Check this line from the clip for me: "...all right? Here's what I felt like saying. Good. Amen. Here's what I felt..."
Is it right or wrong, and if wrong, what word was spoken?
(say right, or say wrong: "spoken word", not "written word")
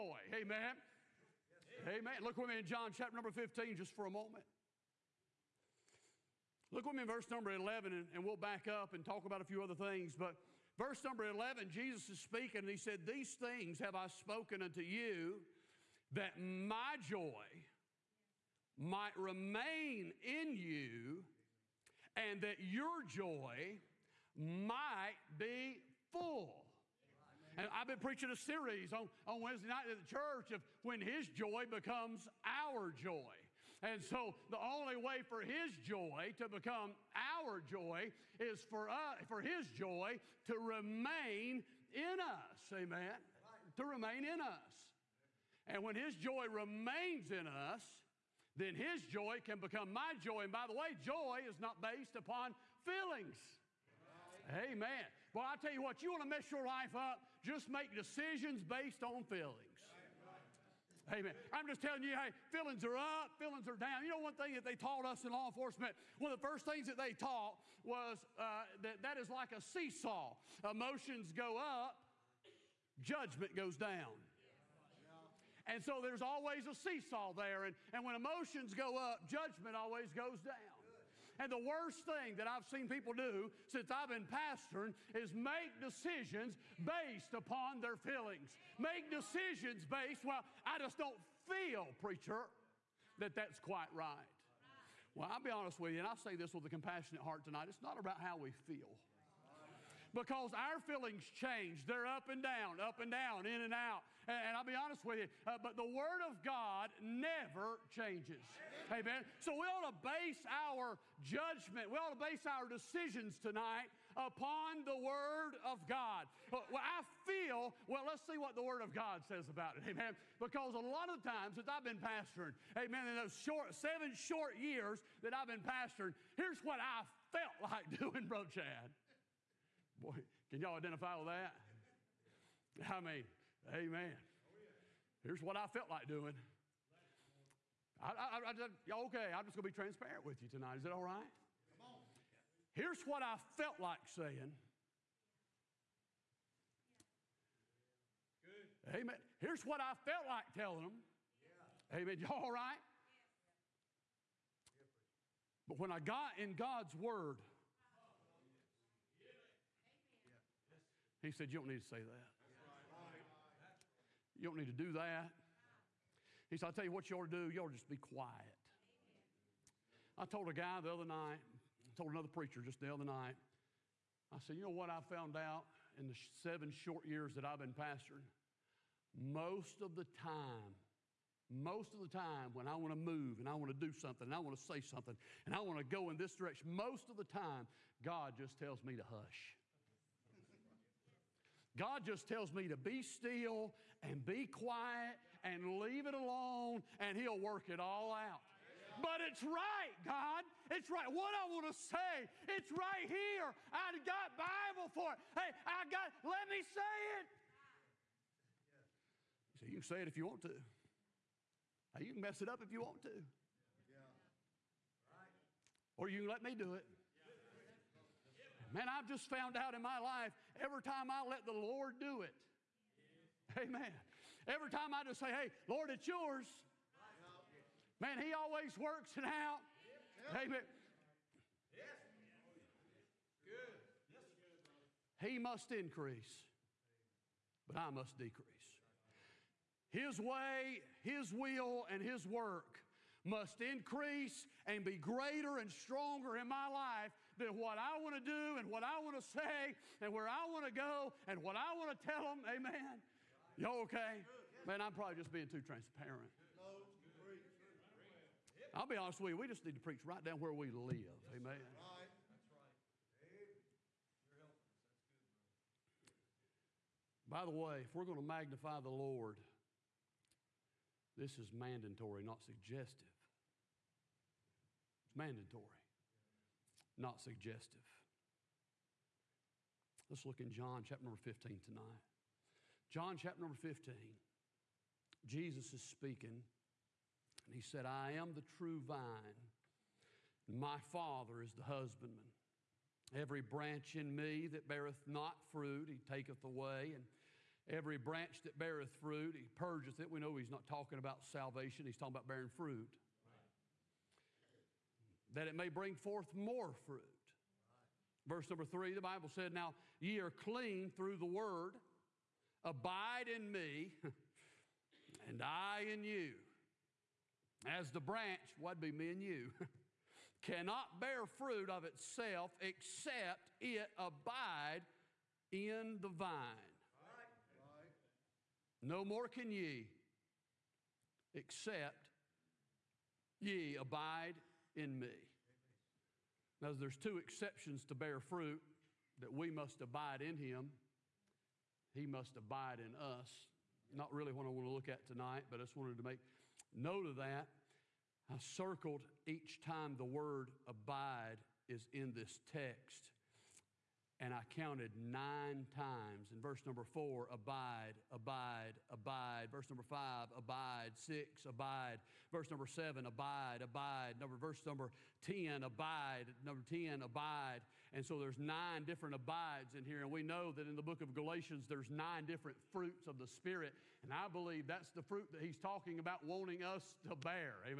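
right.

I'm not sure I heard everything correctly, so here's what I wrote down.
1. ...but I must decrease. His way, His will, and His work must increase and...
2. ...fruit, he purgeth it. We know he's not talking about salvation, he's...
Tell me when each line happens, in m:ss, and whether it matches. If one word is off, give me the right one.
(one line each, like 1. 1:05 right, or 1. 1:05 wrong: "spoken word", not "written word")
1. 3:57 right
2. 4:58 right.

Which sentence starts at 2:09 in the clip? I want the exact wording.
Boy, can y'all identify with that?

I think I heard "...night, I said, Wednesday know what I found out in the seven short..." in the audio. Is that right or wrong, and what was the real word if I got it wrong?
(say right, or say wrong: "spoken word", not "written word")
wrong: "You", not "Wednesday".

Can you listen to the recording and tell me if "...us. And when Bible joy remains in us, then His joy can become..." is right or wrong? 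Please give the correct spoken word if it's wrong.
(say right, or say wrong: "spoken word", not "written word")
wrong: "His", not "Bible".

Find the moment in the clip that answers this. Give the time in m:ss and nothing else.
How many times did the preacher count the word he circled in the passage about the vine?
5:54.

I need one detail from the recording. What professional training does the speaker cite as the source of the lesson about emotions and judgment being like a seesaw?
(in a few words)
law enforcement.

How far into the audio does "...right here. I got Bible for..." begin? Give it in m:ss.
3:22.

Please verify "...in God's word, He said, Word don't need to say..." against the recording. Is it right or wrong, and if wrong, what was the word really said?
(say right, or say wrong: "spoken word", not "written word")
wrong: "You", not "Word".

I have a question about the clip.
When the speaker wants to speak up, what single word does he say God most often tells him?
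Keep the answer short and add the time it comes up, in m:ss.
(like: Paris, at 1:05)
hush, at 3:09.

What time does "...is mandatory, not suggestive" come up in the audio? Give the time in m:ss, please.
4:31.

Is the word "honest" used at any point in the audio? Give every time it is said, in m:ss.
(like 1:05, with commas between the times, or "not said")
1:35, 1:44, 4:18.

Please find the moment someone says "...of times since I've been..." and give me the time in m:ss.
2:01.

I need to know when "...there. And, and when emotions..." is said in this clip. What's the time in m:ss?
1:17.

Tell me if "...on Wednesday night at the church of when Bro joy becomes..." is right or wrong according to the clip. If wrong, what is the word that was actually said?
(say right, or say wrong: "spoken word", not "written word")
wrong: "His", not "Bro".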